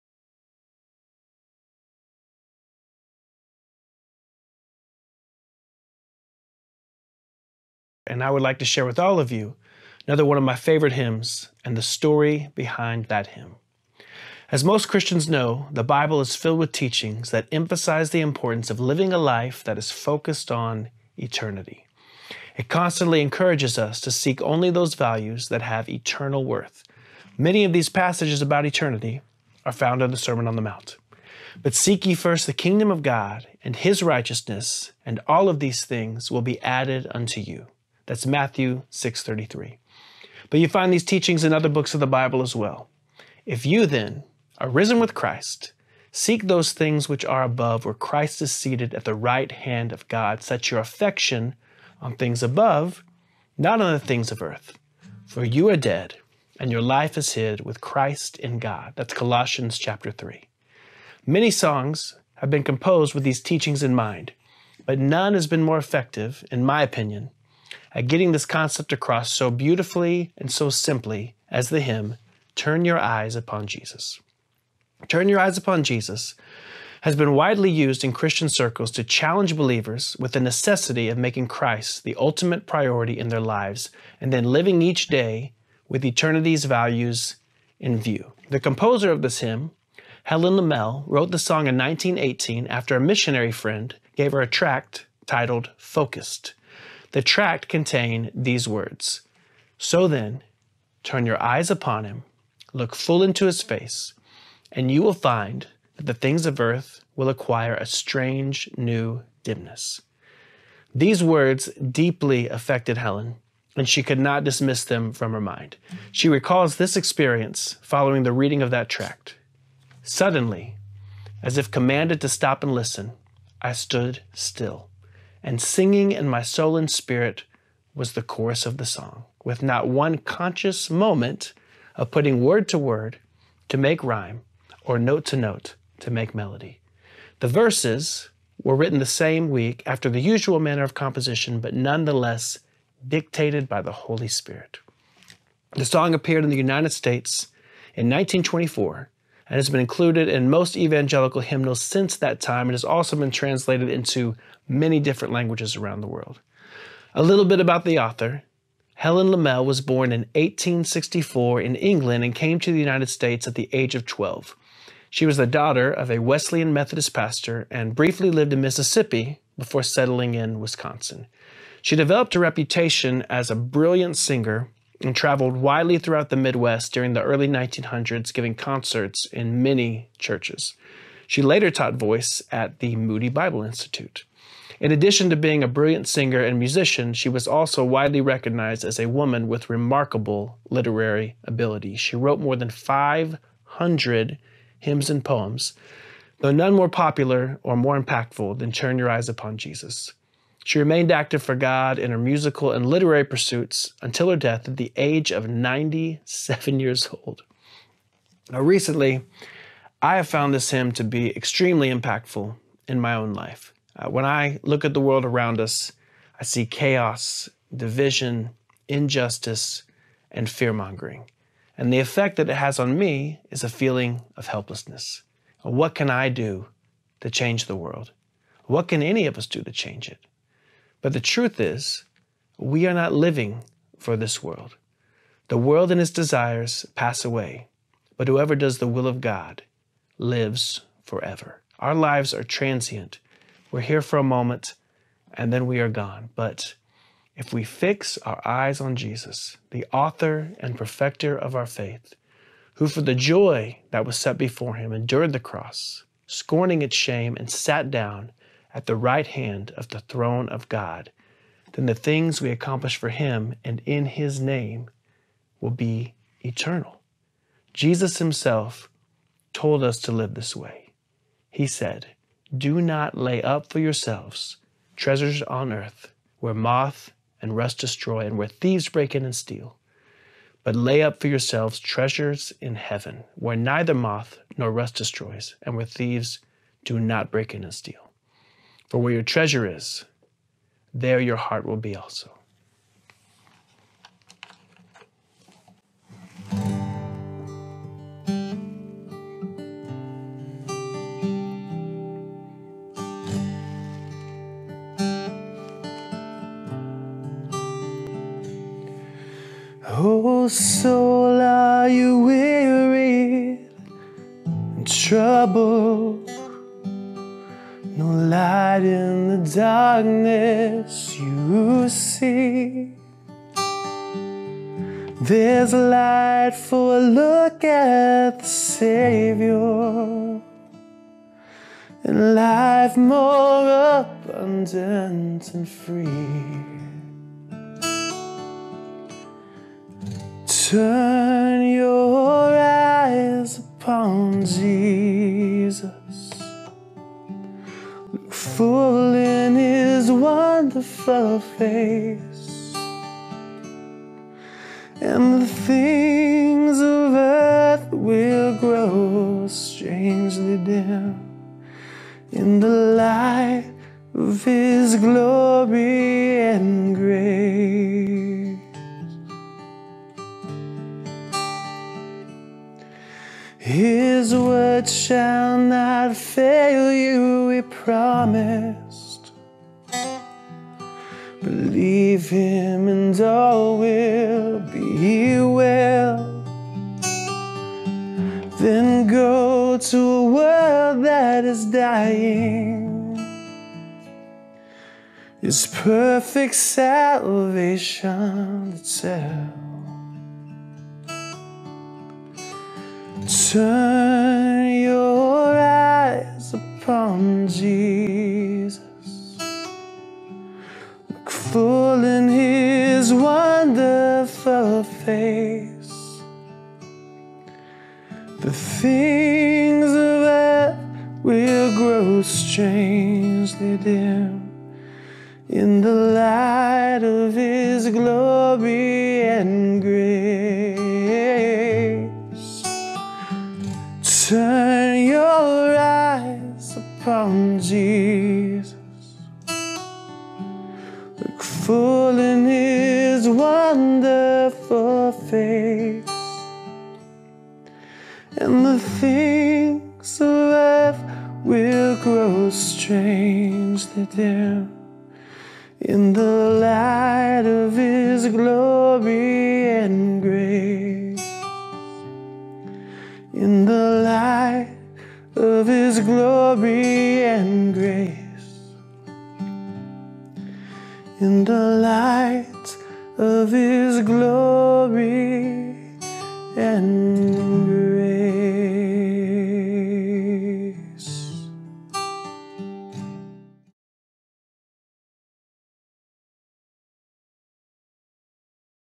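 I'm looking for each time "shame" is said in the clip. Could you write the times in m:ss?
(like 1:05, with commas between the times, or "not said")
4:16.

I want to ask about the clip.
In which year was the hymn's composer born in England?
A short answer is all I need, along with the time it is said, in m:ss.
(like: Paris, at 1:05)
1864, at 2:40.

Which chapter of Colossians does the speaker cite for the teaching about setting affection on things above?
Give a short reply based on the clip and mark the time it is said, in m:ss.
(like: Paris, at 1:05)
chapter 3, at 0:59.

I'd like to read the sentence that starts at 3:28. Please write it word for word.
Now, recently, I have found this hymn to be extremely impactful in my own life.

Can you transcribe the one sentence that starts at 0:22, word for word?
It constantly encourages us to seek only those values that have eternal worth.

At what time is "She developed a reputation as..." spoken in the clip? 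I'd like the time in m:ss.
2:51.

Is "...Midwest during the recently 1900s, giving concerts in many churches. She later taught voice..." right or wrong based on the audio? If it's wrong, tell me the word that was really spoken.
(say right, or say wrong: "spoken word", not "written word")
wrong: "early", not "recently".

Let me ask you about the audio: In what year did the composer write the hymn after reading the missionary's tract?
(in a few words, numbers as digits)
1918.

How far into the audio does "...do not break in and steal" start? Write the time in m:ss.
4:46.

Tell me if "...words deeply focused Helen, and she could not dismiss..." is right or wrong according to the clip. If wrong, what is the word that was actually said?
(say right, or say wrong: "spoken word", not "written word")
wrong: "affected", not "focused".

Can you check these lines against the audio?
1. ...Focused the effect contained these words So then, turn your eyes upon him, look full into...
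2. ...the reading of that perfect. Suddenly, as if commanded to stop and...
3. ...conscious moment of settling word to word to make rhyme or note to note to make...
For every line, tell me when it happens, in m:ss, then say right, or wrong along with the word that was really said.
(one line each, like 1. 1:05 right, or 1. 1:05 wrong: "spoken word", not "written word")
1. 1:35 wrong: "tract", not "effect"
2. 1:58 wrong: "tract", not "perfect"
3. 2:10 wrong: "putting", not "settling".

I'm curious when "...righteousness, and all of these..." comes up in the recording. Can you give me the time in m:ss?
0:34.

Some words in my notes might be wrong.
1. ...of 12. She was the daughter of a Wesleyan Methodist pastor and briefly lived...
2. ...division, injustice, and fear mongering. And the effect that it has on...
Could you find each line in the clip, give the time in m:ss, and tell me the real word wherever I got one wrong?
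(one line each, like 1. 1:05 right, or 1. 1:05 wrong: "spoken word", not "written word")
1. 2:43 right
2. 3:37 right.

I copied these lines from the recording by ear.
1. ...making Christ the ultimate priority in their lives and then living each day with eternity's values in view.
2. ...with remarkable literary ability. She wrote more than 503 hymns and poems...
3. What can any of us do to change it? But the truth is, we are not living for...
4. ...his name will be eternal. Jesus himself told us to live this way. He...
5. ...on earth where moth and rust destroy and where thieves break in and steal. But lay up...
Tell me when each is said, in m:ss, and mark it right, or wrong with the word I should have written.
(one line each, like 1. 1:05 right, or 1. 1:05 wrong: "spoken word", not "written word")
1. 1:21 right
2. 3:09 wrong: "500", not "503"
3. 3:48 right
4. 4:24 right
5. 4:35 right.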